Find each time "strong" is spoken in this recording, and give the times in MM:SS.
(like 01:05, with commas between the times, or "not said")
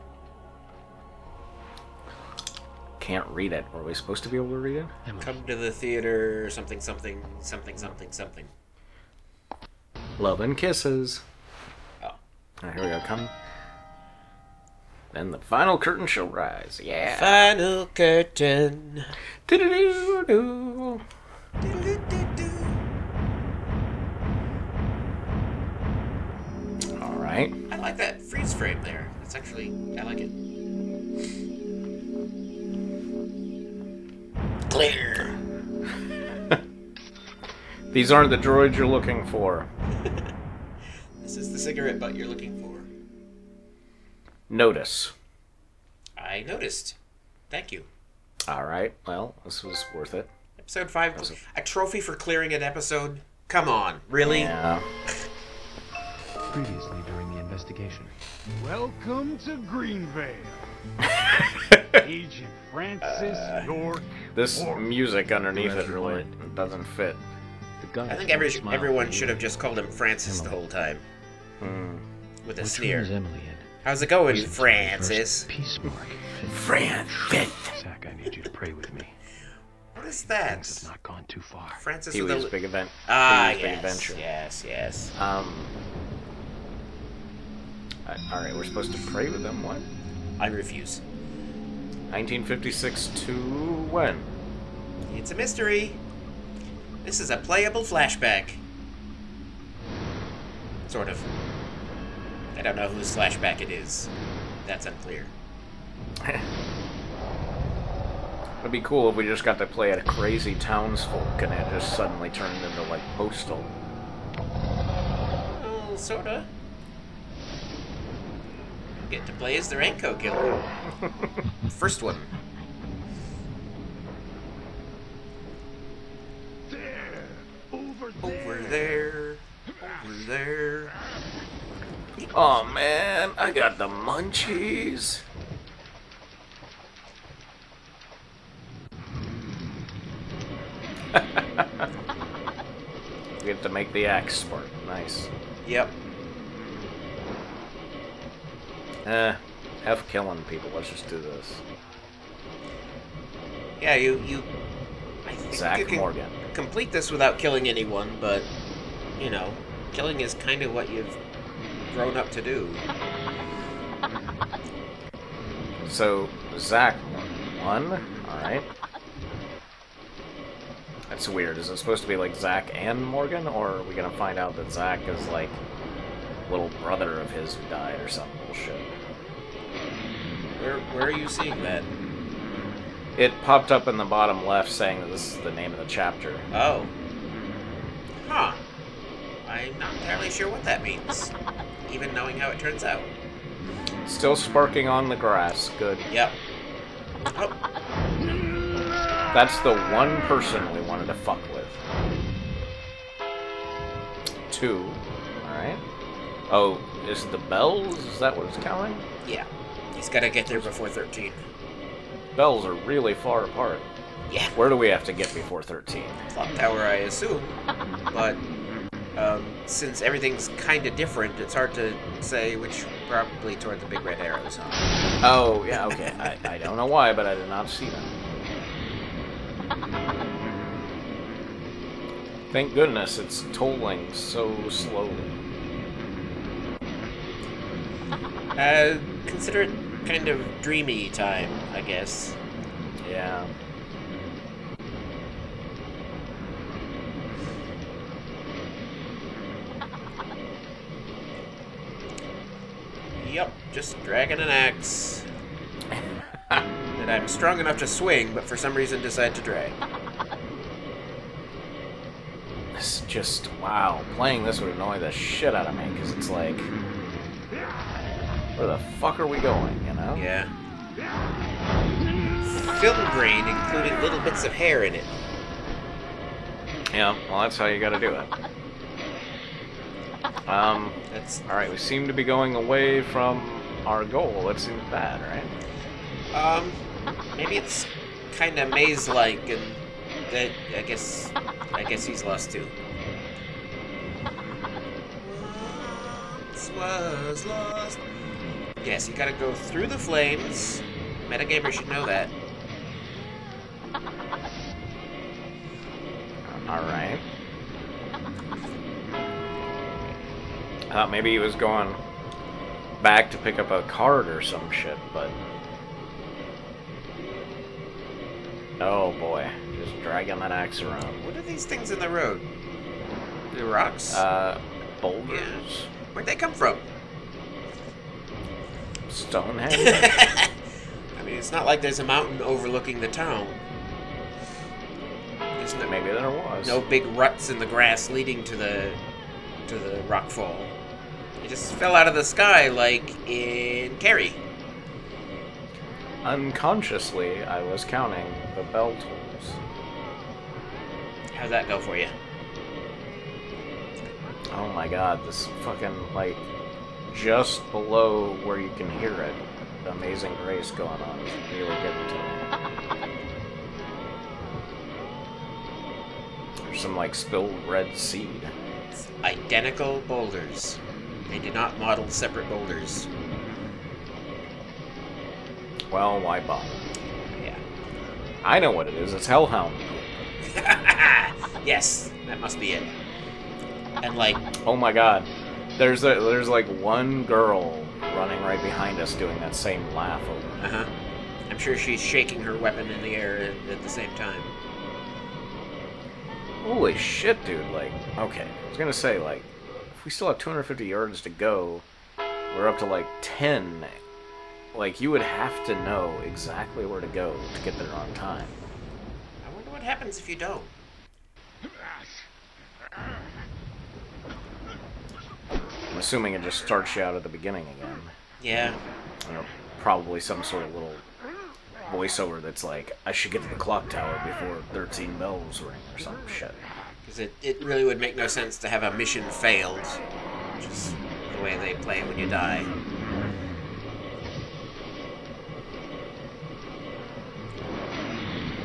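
04:17.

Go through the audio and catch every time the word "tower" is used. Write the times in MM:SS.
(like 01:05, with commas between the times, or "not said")
03:36, 07:03.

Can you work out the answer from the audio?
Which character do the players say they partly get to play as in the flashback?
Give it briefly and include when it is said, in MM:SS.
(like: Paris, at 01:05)
the Raincoat Killer, at 01:59.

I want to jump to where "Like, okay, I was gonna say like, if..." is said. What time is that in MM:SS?
06:37.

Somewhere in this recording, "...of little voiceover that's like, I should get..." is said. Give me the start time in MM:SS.
07:00.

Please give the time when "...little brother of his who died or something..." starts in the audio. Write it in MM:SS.
02:56.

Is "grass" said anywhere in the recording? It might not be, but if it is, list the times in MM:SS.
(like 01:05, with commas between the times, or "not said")
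03:15, 05:37.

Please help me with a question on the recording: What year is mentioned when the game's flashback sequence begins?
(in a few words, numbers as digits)
1956.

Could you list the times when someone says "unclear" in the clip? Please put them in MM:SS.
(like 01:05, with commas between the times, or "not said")
01:44.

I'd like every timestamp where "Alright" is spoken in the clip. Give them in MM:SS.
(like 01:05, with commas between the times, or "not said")
03:25, 04:41, 05:06.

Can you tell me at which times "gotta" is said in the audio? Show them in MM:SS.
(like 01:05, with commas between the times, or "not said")
04:37, 04:59.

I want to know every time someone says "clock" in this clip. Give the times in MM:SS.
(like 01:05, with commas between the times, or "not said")
03:36, 07:03.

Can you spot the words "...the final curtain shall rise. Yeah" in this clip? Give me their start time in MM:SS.
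00:15.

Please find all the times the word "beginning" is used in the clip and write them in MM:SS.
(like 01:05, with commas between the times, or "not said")
06:57.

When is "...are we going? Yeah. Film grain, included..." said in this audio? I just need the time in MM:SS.
04:29.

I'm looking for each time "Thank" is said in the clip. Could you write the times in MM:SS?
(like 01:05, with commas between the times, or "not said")
00:47, 03:52.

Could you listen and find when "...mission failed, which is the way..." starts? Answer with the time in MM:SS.
07:08.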